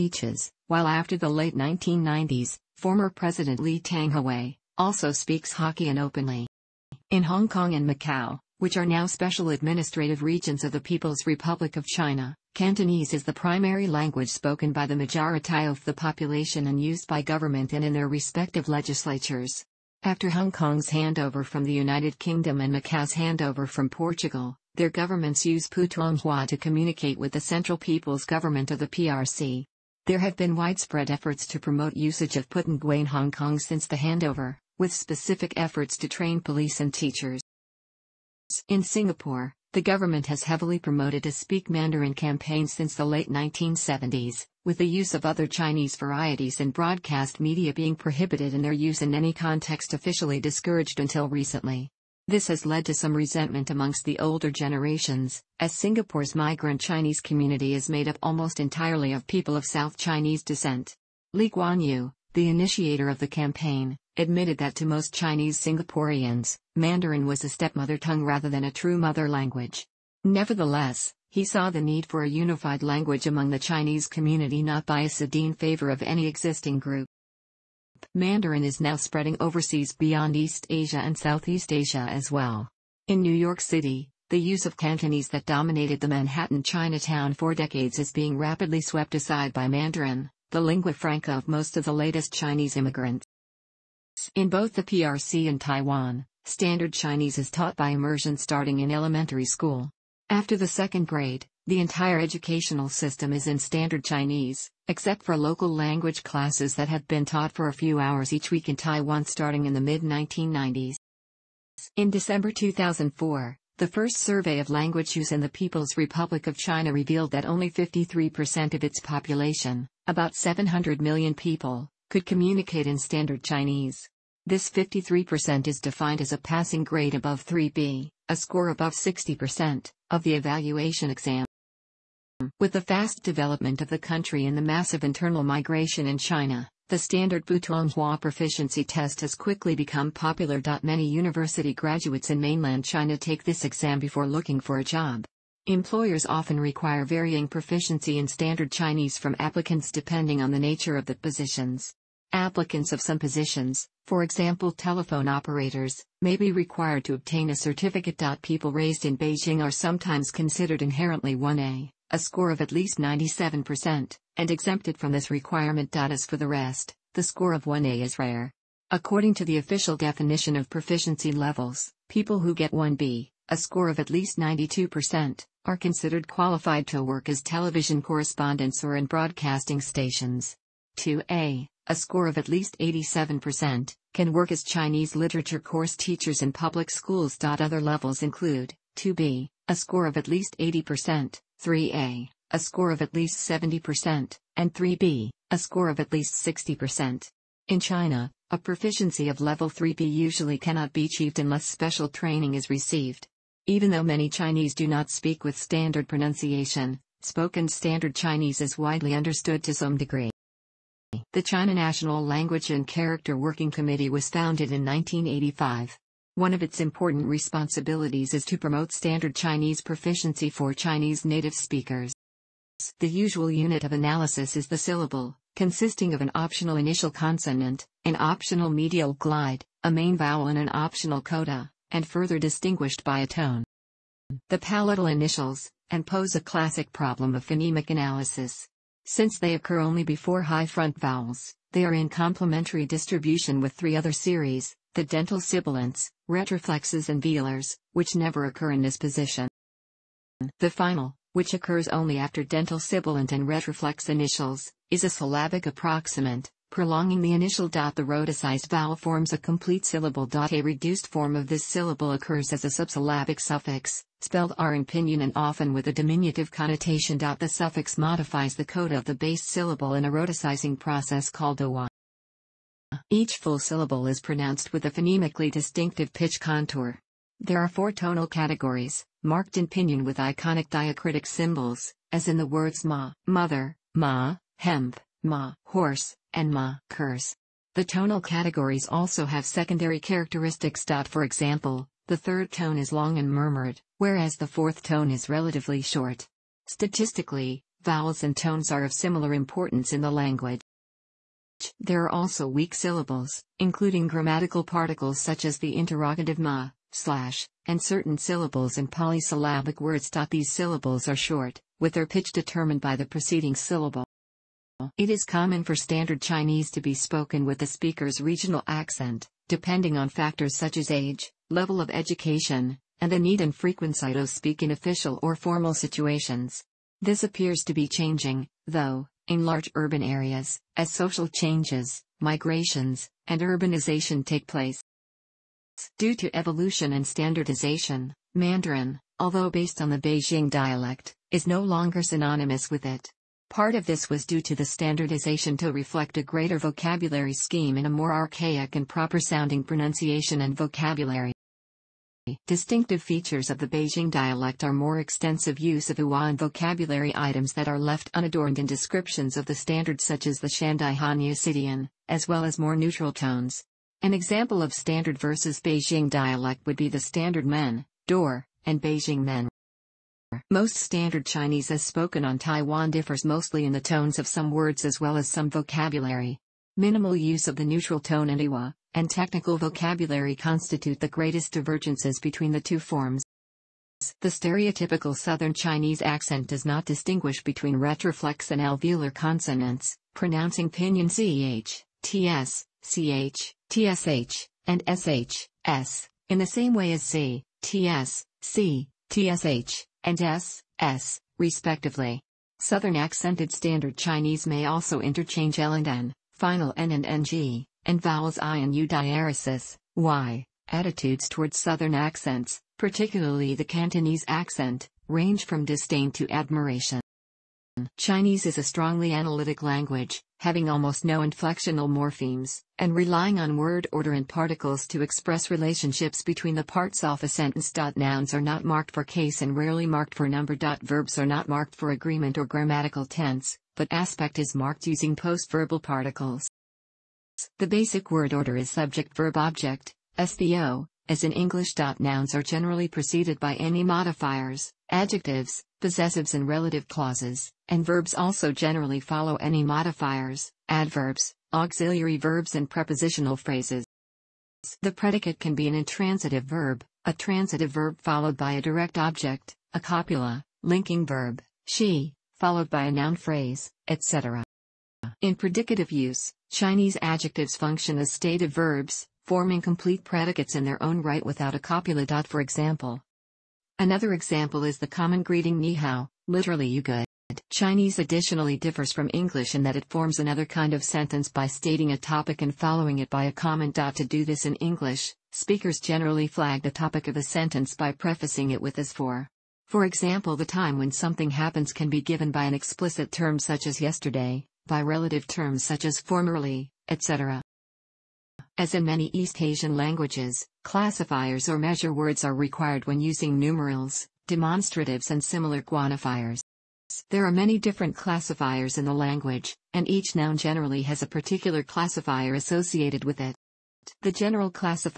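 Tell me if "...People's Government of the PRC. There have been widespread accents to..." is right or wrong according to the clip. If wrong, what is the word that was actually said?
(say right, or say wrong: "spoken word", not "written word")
wrong: "efforts", not "accents".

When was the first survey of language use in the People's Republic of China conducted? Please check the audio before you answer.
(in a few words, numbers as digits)
December 2004.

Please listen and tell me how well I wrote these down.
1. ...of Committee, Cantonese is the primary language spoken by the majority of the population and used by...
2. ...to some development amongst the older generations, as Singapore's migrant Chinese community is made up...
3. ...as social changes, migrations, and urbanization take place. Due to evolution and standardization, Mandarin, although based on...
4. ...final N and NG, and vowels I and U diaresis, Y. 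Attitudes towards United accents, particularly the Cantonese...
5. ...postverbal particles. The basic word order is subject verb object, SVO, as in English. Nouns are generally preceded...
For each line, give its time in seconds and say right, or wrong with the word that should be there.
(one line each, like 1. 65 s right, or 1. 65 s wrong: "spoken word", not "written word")
1. 11 s wrong: "China", not "Committee"
2. 52 s wrong: "resentment", not "development"
3. 330 s right
4. 406 s wrong: "Southern", not "United"
5. 435 s right.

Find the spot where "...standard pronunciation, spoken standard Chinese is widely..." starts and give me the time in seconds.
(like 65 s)
205 s.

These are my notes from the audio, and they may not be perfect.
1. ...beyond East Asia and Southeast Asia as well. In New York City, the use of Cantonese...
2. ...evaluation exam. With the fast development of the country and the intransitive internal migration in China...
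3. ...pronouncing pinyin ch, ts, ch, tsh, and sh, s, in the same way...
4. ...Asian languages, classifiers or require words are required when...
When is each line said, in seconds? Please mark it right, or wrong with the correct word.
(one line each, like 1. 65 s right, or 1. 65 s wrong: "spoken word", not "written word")
1. 79 s right
2. 130 s wrong: "massive", not "intransitive"
3. 390 s right
4. 499 s wrong: "measure", not "require".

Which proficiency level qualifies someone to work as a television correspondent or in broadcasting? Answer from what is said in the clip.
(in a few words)
1B.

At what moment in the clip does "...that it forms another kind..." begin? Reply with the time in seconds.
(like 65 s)
479 s.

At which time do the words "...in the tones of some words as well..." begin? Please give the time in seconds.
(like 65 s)
373 s.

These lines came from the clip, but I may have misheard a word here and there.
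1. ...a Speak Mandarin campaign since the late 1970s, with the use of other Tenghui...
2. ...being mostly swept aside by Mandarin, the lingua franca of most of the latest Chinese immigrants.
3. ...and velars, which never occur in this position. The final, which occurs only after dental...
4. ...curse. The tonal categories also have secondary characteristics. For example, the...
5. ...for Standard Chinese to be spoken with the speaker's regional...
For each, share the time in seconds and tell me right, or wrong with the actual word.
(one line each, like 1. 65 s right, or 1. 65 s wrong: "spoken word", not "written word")
1. 41 s wrong: "Chinese", not "Tenghui"
2. 88 s wrong: "rapidly", not "mostly"
3. 247 s right
4. 286 s right
5. 315 s right.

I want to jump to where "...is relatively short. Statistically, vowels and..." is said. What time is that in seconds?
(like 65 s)
295 s.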